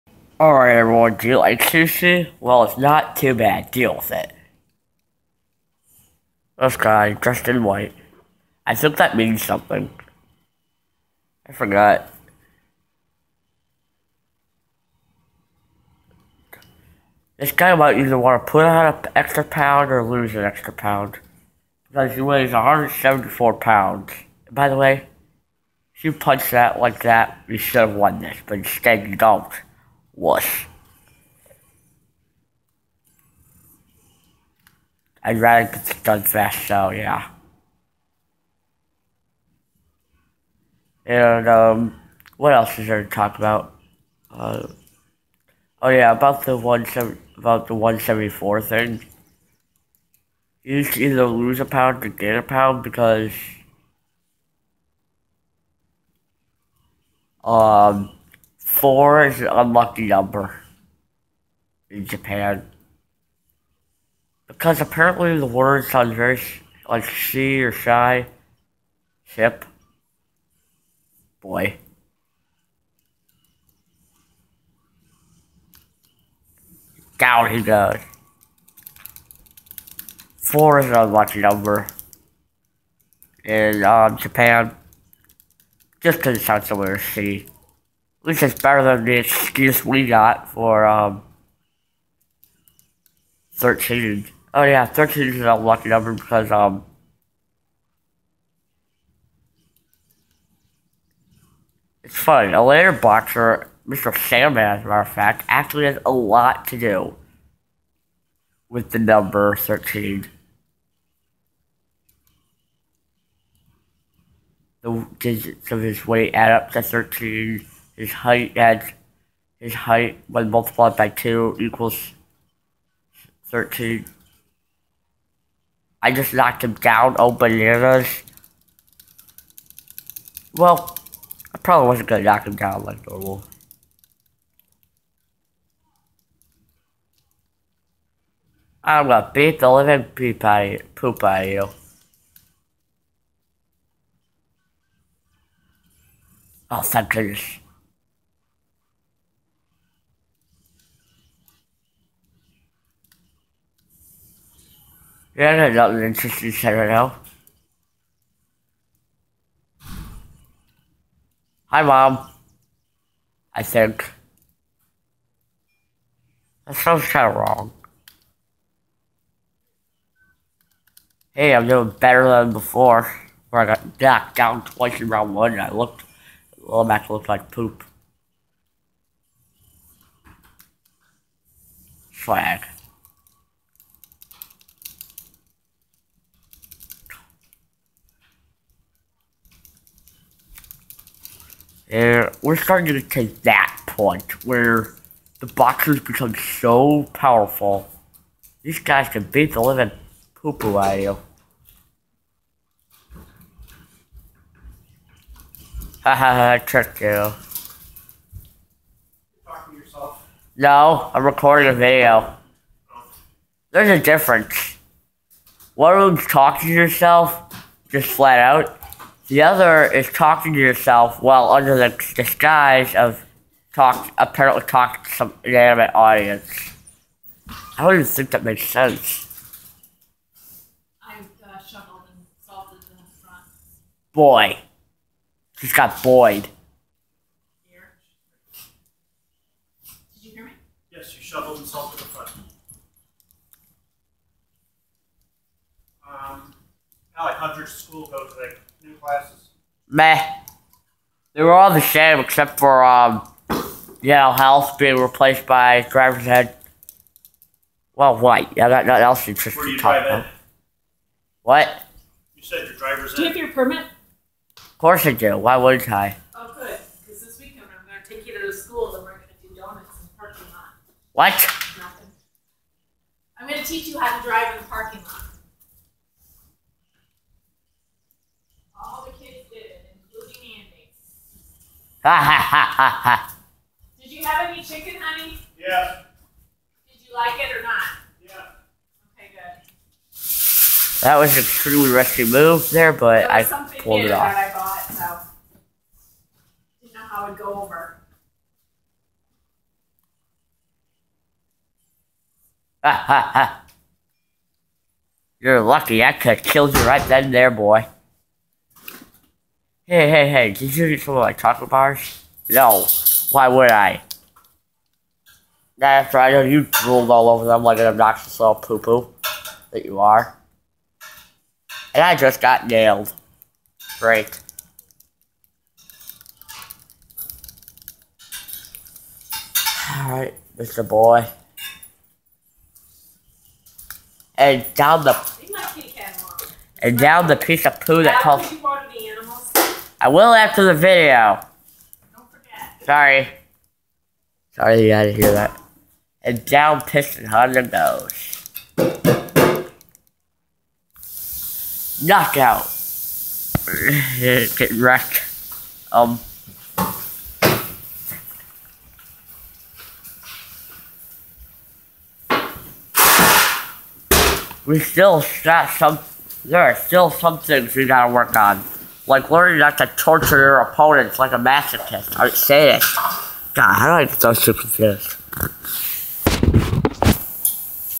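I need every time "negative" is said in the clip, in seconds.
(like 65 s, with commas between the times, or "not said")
not said.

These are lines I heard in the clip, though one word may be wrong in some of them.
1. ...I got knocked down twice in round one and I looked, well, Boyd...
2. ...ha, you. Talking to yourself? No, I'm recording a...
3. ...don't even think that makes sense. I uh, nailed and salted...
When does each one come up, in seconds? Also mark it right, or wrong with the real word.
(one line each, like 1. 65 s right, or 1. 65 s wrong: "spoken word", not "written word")
1. 173 s wrong: "Mac", not "Boyd"
2. 206 s right
3. 227 s wrong: "shoveled", not "nailed".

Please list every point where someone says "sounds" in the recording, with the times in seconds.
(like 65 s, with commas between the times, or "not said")
65 s, 86 s, 166 s.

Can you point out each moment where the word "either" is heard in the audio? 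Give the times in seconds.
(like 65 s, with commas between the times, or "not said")
17 s, 50 s.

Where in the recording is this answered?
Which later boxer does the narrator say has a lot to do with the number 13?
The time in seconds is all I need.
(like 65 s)
103 s.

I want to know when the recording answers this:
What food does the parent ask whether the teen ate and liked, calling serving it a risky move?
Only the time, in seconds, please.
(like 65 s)
284 s.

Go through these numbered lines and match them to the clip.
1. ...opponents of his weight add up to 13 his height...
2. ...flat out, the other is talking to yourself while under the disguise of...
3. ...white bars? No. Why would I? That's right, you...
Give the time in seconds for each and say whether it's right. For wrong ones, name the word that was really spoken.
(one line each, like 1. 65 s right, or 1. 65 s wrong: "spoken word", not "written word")
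1. 115 s wrong: "digits", not "opponents"
2. 218 s right
3. 311 s wrong: "chocolate", not "white".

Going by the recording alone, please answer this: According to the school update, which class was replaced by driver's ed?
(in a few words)
Health.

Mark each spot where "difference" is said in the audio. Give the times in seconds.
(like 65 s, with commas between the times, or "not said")
214 s.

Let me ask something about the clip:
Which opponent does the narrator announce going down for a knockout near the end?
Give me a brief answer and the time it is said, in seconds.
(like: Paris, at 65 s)
Piston Hondo, at 346 s.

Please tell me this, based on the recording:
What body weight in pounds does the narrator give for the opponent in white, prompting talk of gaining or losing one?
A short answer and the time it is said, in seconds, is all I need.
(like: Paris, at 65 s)
174, at 22 s.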